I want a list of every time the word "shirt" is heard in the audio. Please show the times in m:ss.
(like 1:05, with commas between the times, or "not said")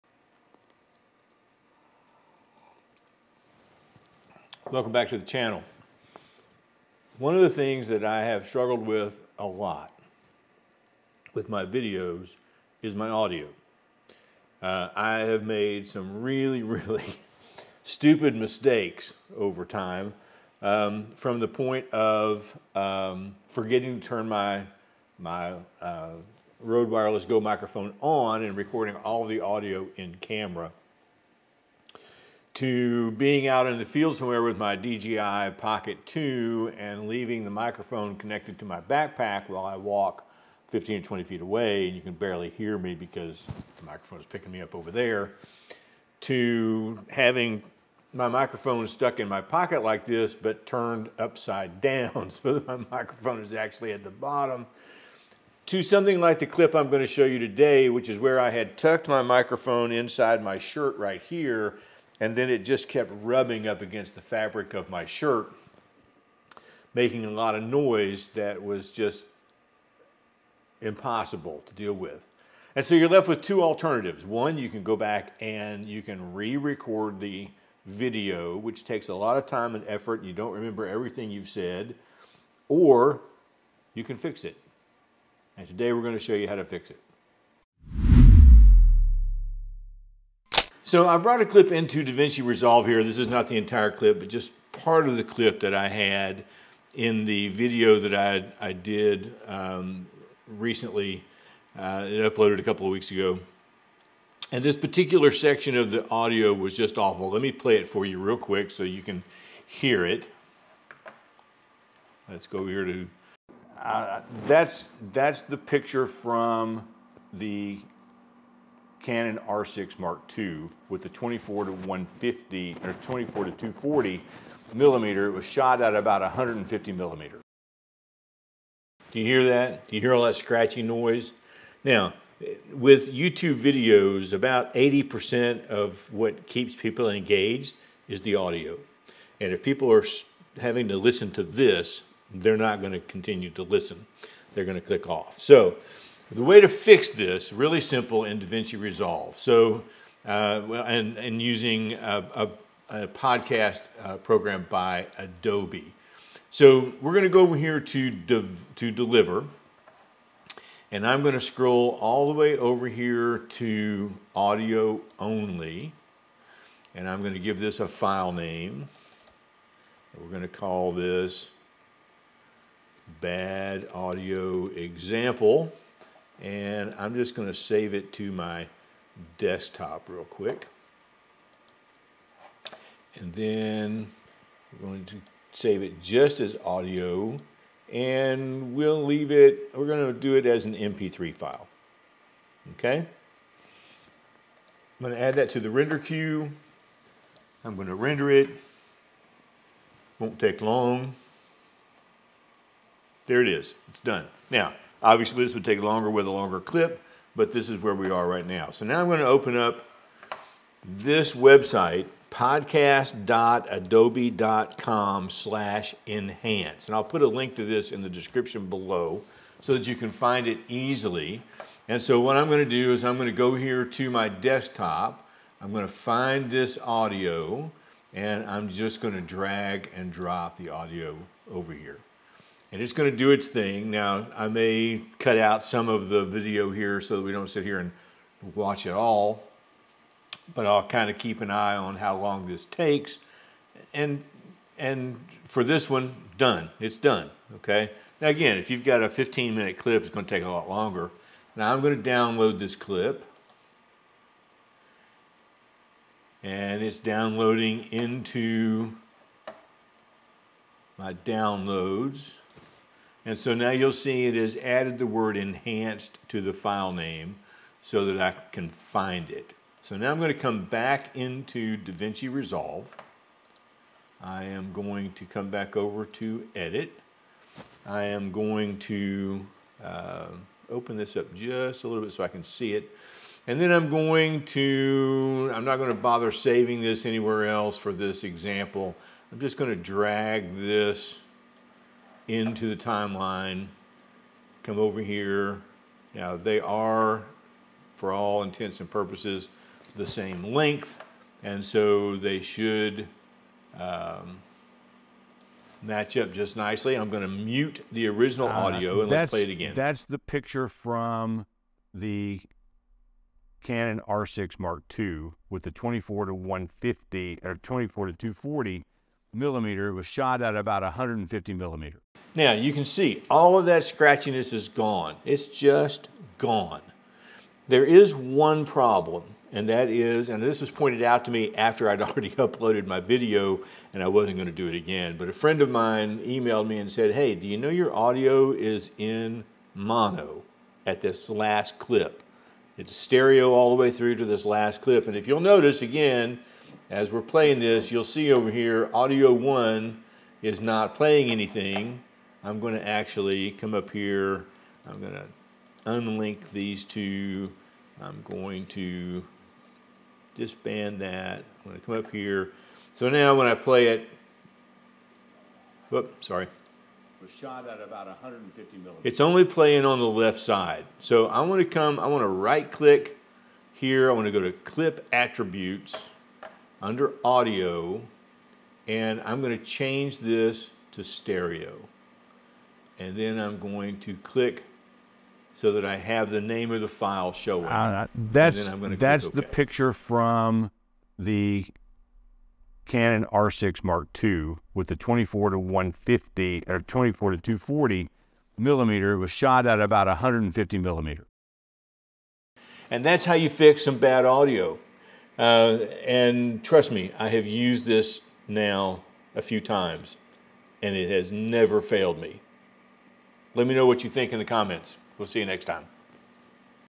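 1:00, 1:05.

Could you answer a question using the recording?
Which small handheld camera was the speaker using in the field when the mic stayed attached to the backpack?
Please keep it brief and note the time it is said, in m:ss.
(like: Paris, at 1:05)
DJI Pocket 2, at 0:34.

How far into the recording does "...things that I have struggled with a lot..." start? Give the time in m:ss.
0:07.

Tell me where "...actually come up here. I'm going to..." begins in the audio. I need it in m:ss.
5:52.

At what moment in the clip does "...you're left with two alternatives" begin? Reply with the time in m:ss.
1:12.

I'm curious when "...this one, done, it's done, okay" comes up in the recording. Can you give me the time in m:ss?
4:05.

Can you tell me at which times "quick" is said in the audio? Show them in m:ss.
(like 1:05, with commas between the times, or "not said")
1:48, 3:00.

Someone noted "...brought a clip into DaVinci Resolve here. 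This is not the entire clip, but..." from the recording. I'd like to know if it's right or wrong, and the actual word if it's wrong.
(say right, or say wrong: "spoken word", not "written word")
right.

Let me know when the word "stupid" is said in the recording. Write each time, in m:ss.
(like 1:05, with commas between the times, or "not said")
0:17.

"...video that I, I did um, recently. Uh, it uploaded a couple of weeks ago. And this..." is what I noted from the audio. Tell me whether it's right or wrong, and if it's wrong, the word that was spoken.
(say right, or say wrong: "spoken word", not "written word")
right.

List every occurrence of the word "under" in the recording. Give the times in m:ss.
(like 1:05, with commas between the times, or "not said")
6:16.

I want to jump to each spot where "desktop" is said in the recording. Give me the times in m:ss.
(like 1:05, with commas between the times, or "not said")
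2:59, 3:44.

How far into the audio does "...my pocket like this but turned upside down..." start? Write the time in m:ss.
0:49.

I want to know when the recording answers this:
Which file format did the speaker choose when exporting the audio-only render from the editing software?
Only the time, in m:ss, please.
3:10.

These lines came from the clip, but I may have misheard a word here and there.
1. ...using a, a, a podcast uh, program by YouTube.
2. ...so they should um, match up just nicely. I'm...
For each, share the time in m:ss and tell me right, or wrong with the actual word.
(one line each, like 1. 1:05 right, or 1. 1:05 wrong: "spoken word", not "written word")
1. 2:31 wrong: "Adobe", not "YouTube"
2. 5:01 right.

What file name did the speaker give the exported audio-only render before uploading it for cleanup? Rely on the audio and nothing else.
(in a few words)
bad audio example.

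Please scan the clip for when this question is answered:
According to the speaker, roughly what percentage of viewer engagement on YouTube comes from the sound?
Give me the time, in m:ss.
2:14.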